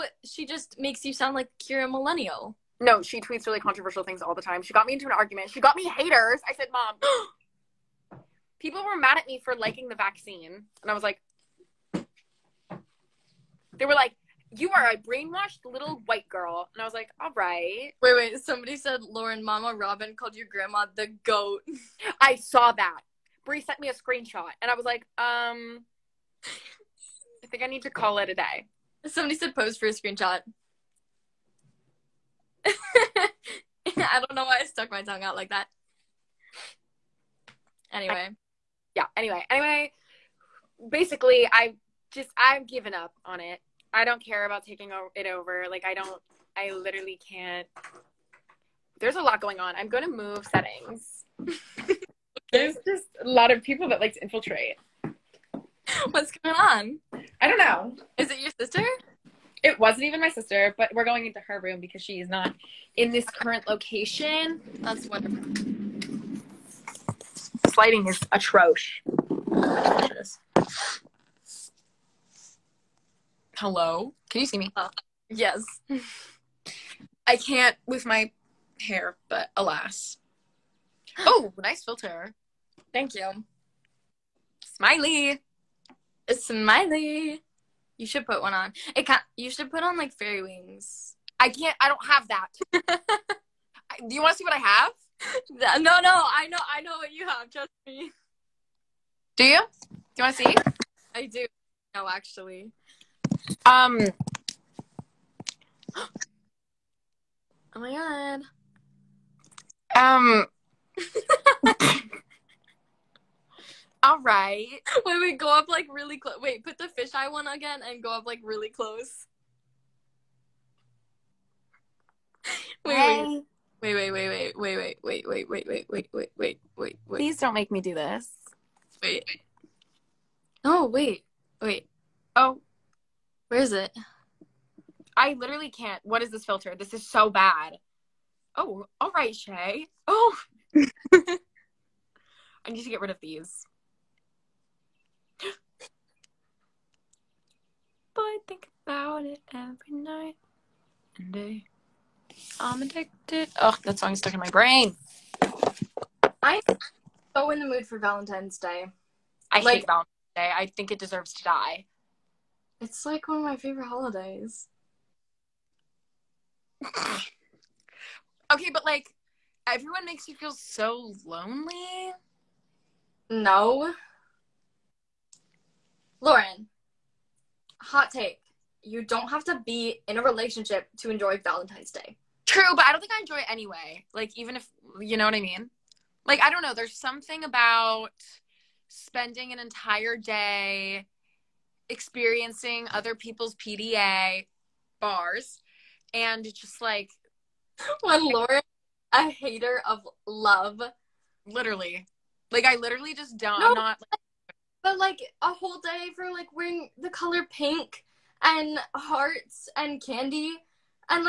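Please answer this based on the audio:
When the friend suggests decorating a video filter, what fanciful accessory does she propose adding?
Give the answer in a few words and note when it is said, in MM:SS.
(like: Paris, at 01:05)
fairy wings, at 01:30.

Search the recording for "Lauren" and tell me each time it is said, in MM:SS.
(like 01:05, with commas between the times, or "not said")
00:19, 02:56, 03:18.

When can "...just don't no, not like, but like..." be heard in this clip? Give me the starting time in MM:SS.
03:23.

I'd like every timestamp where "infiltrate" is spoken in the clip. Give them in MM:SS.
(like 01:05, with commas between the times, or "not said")
00:54.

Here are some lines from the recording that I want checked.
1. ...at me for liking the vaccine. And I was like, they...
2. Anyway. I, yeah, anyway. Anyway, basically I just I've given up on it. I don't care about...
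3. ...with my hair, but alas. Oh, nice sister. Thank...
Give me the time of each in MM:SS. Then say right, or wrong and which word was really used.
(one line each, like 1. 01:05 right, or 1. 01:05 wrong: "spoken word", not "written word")
1. 00:09 right
2. 00:37 right
3. 01:17 wrong: "filter", not "sister".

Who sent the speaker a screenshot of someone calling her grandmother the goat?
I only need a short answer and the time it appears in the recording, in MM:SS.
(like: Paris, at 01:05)
Bree, at 00:23.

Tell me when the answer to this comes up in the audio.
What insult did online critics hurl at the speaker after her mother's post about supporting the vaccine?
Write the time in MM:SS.
00:14.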